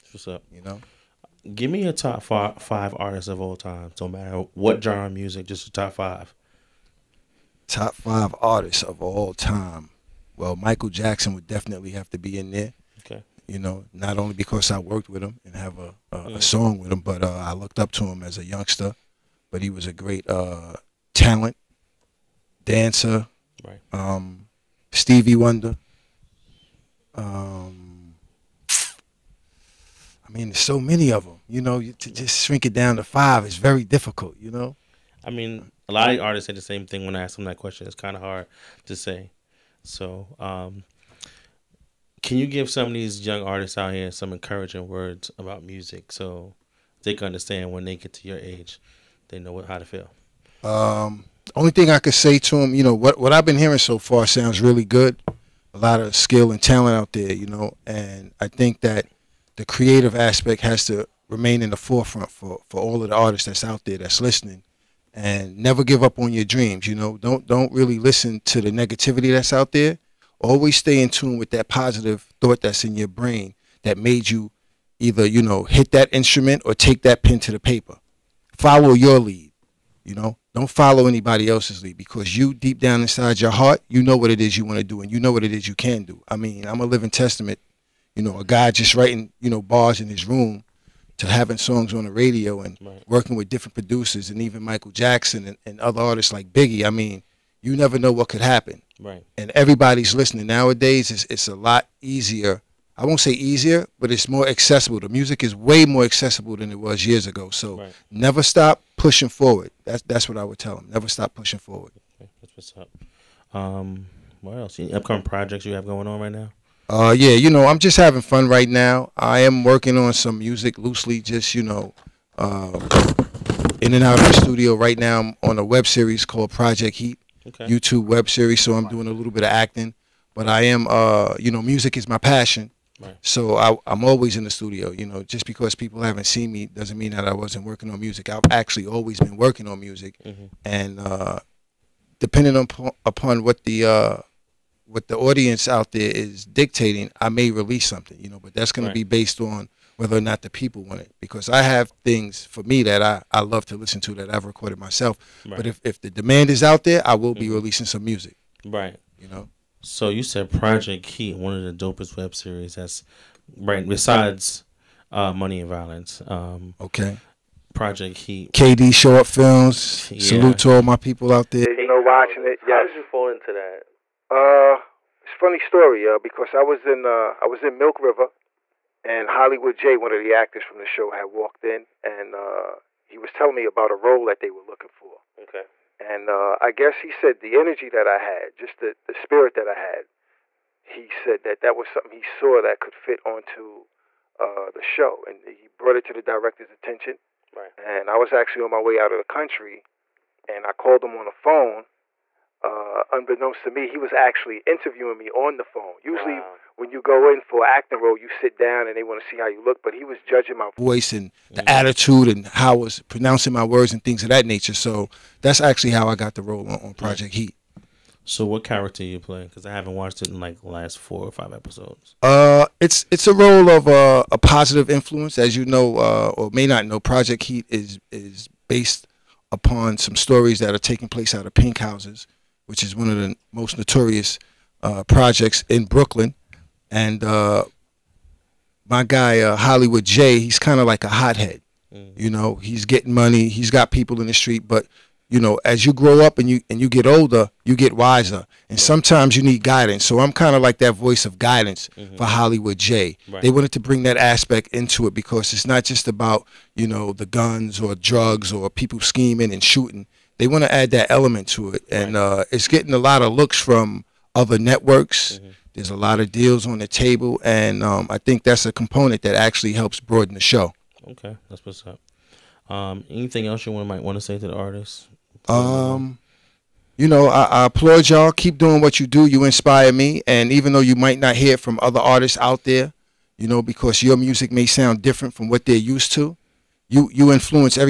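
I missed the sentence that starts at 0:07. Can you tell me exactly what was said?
Top five artists of all time.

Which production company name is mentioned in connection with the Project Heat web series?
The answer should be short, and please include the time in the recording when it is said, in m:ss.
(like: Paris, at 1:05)
KD Short Films, at 2:48.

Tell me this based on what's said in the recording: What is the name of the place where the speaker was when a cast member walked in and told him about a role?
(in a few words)
Milk River.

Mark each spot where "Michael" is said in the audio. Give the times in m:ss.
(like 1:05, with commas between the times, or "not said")
0:10, 1:34.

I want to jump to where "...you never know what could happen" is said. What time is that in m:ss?
1:37.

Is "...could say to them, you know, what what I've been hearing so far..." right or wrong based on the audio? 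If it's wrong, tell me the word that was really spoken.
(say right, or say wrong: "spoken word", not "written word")
right.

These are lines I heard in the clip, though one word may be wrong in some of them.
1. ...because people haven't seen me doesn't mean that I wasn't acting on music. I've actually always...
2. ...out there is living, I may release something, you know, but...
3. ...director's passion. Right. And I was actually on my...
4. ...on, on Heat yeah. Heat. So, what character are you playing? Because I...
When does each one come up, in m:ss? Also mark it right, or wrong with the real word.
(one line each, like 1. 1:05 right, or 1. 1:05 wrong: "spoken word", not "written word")
1. 2:15 wrong: "working", not "acting"
2. 2:25 wrong: "dictating", not "living"
3. 3:16 wrong: "attention", not "passion"
4. 3:36 wrong: "Project", not "Heat".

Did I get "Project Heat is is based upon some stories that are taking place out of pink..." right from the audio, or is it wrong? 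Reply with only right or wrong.
right.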